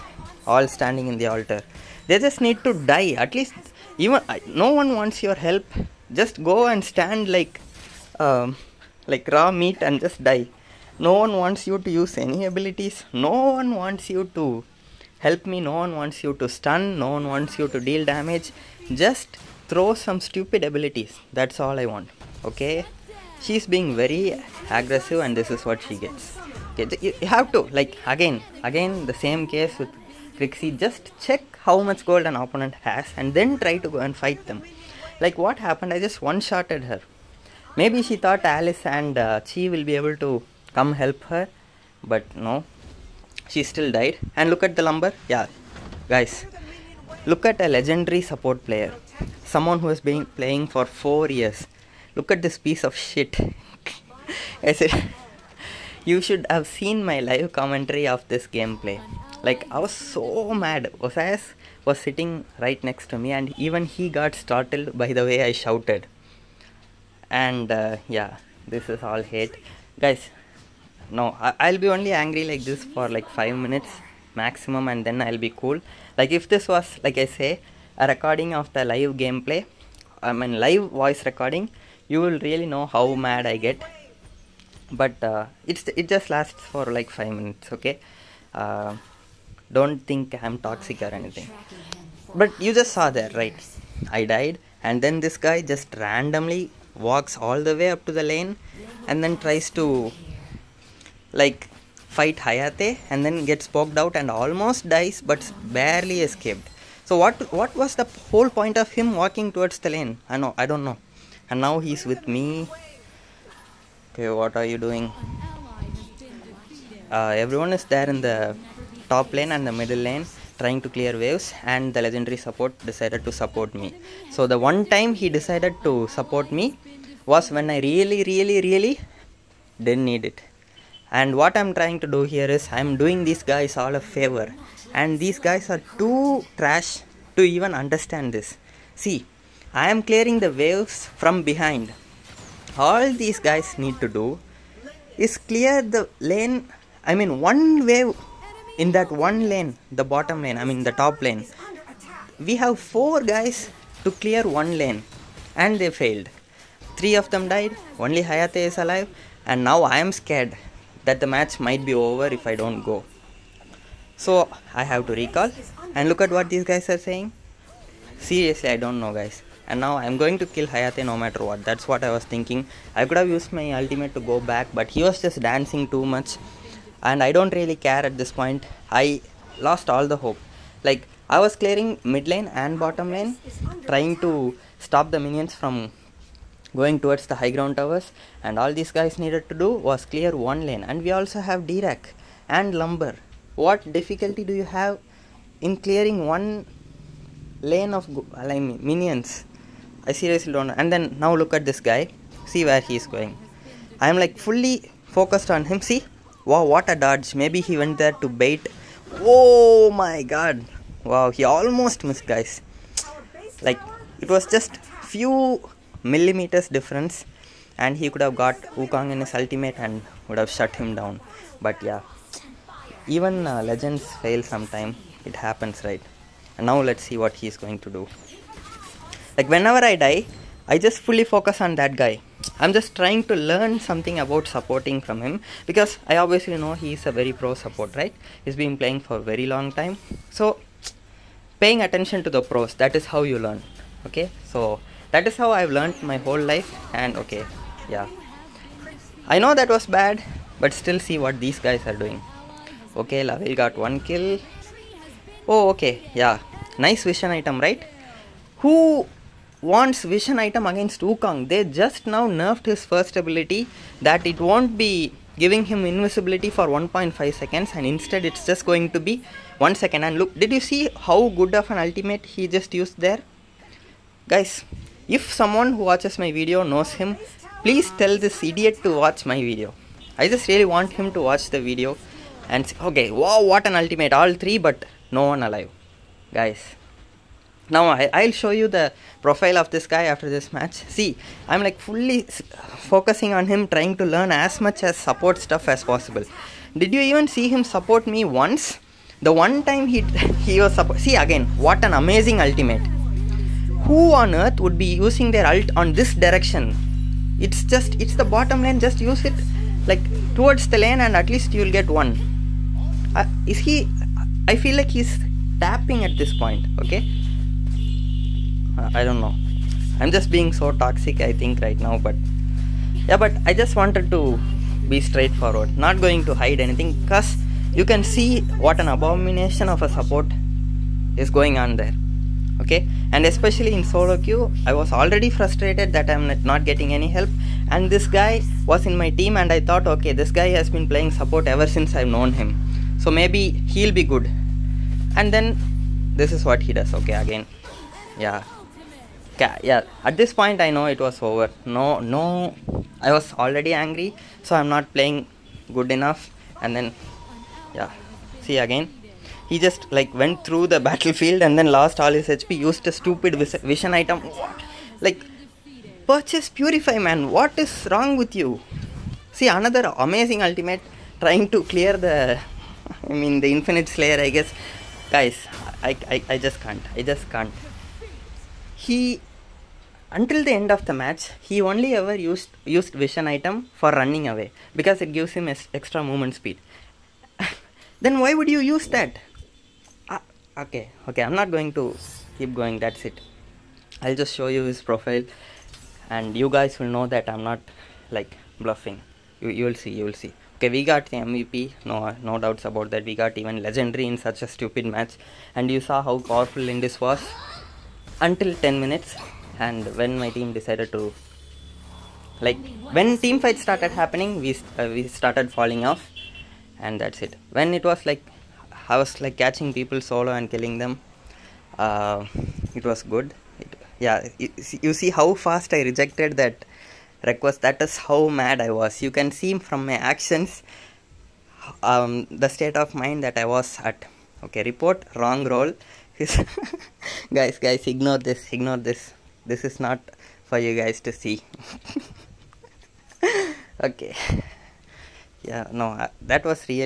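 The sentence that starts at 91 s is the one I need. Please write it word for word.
Oh, but you just saw there, right?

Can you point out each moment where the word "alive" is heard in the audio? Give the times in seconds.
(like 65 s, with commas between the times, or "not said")
158 s, 285 s.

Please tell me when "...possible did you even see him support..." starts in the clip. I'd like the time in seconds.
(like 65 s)
295 s.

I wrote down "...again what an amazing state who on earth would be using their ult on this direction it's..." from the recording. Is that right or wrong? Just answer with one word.
wrong.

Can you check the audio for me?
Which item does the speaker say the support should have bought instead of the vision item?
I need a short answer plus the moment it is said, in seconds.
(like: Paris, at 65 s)
Purify, at 366 s.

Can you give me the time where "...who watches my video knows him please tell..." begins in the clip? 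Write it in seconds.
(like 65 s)
275 s.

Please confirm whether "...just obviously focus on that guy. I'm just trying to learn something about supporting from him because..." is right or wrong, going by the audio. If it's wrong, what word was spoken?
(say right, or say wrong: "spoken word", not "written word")
wrong: "fully", not "obviously".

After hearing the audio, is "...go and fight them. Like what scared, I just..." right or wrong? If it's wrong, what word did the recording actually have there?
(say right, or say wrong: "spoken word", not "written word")
wrong: "happened", not "scared".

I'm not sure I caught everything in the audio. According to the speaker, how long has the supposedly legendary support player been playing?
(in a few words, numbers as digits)
4 years.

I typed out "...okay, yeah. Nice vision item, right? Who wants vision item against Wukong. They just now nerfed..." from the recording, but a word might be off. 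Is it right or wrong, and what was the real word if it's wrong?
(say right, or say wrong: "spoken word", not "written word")
right.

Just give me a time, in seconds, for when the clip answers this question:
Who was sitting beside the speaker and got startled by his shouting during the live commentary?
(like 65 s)
61 s.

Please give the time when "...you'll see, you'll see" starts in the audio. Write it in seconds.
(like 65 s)
399 s.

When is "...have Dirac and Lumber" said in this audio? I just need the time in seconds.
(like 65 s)
191 s.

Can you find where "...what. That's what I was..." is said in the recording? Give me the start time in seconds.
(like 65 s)
171 s.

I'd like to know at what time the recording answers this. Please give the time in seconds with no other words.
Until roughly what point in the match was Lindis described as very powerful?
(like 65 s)
408 s.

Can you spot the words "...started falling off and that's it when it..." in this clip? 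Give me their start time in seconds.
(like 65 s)
415 s.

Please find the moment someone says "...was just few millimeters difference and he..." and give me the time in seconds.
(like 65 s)
214 s.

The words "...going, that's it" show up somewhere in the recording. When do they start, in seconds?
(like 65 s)
392 s.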